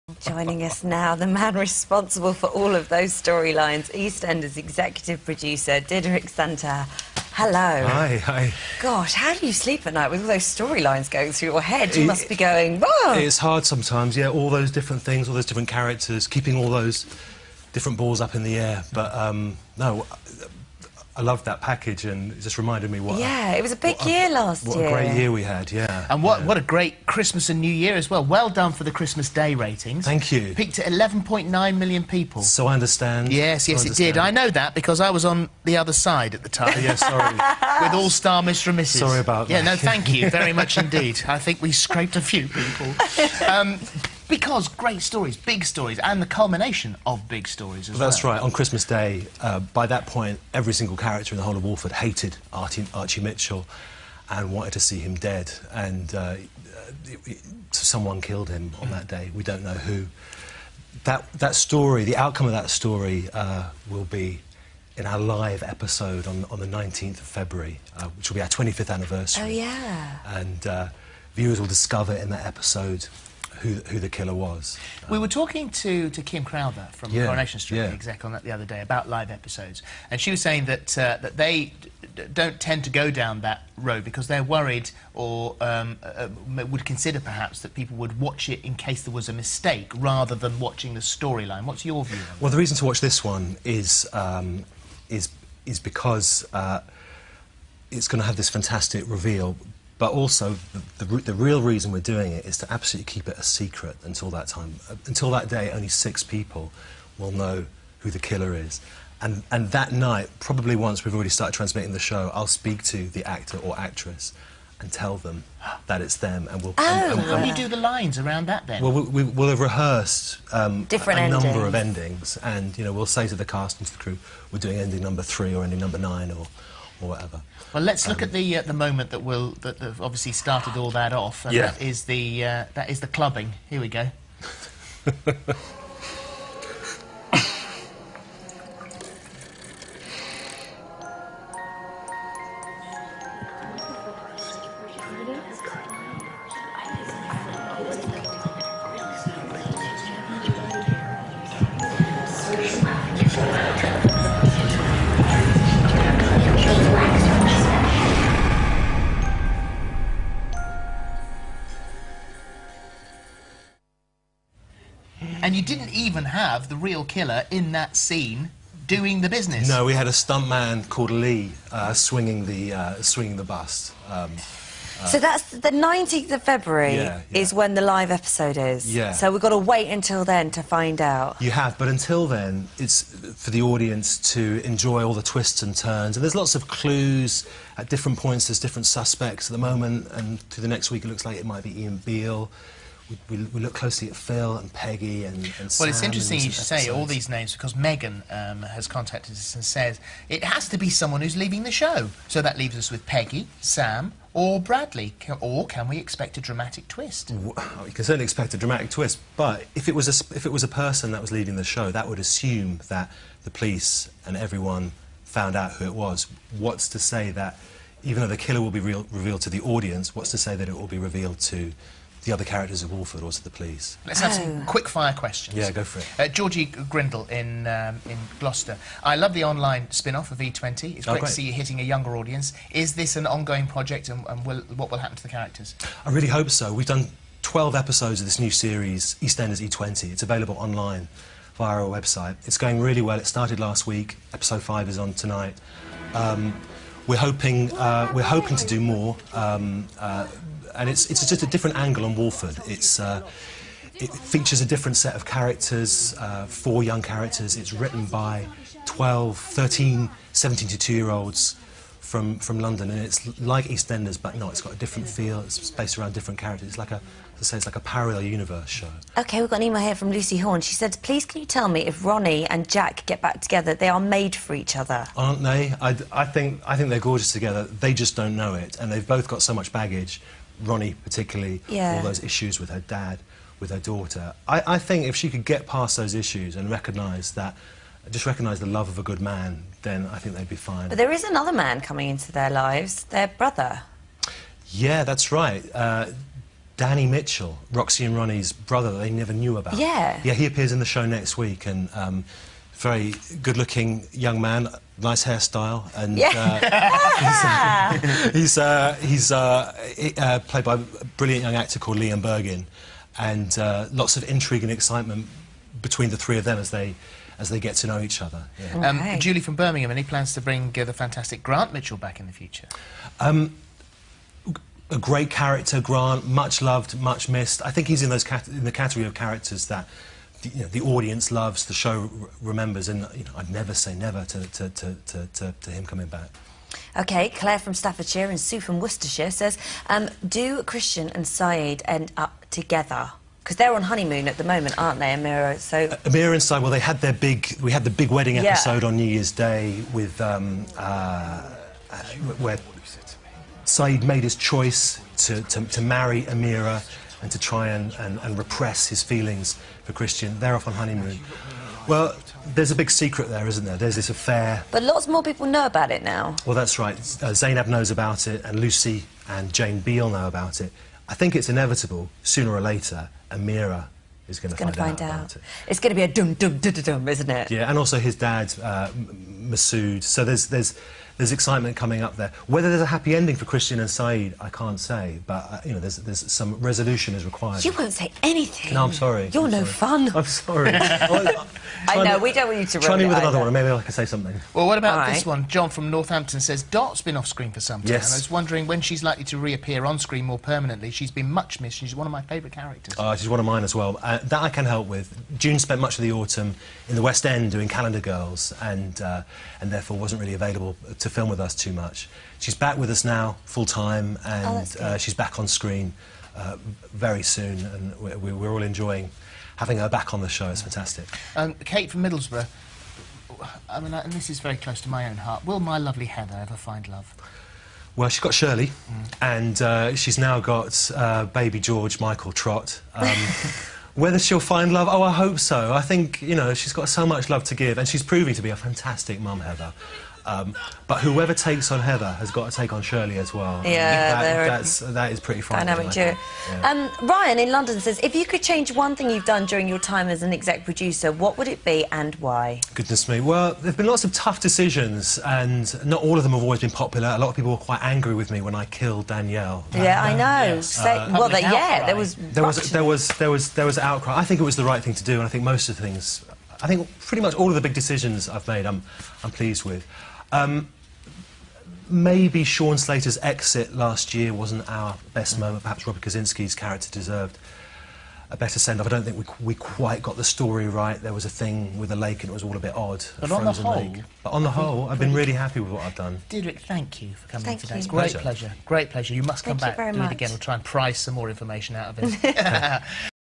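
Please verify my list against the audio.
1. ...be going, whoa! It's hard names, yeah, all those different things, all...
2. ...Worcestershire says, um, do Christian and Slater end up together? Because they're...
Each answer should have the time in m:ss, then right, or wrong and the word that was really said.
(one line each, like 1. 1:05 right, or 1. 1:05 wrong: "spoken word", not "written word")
1. 0:12 wrong: "sometimes", not "names"
2. 5:38 wrong: "Syed", not "Slater".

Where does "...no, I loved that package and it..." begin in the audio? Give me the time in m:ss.
0:19.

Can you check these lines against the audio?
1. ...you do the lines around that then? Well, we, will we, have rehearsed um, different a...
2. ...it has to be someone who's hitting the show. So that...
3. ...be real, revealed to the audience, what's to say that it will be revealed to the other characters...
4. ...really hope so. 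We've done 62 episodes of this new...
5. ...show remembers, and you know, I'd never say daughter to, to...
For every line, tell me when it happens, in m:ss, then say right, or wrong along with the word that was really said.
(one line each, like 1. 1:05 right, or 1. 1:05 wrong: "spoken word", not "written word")
1. 1:57 right
2. 3:20 wrong: "leaving", not "hitting"
3. 3:38 right
4. 3:56 wrong: "12", not "62"
5. 5:31 wrong: "never", not "daughter".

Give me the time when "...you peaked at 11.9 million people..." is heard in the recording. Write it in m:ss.
0:30.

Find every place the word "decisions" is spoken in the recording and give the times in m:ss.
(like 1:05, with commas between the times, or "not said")
7:34, 7:47.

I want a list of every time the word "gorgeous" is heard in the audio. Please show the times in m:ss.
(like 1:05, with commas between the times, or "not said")
4:36.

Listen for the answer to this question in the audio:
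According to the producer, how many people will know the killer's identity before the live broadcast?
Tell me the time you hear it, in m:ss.
1:45.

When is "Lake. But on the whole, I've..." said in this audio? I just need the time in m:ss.
8:03.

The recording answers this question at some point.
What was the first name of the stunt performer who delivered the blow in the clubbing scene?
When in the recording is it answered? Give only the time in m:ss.
2:51.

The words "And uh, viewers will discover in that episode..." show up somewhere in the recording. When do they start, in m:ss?
1:10.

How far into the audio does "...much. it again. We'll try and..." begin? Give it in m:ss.
8:09.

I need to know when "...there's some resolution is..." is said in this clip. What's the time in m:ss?
6:25.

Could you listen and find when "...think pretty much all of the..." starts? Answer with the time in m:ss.
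7:46.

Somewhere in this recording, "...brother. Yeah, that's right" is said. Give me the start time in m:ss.
4:53.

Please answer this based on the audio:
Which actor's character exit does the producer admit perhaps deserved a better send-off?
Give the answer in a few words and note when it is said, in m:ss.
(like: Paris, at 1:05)
Robert Kazinsky, at 7:55.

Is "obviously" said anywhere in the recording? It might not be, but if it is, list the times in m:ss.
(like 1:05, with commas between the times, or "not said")
2:09.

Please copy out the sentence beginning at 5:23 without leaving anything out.
Um, a great character, Grant, much loved, much missed.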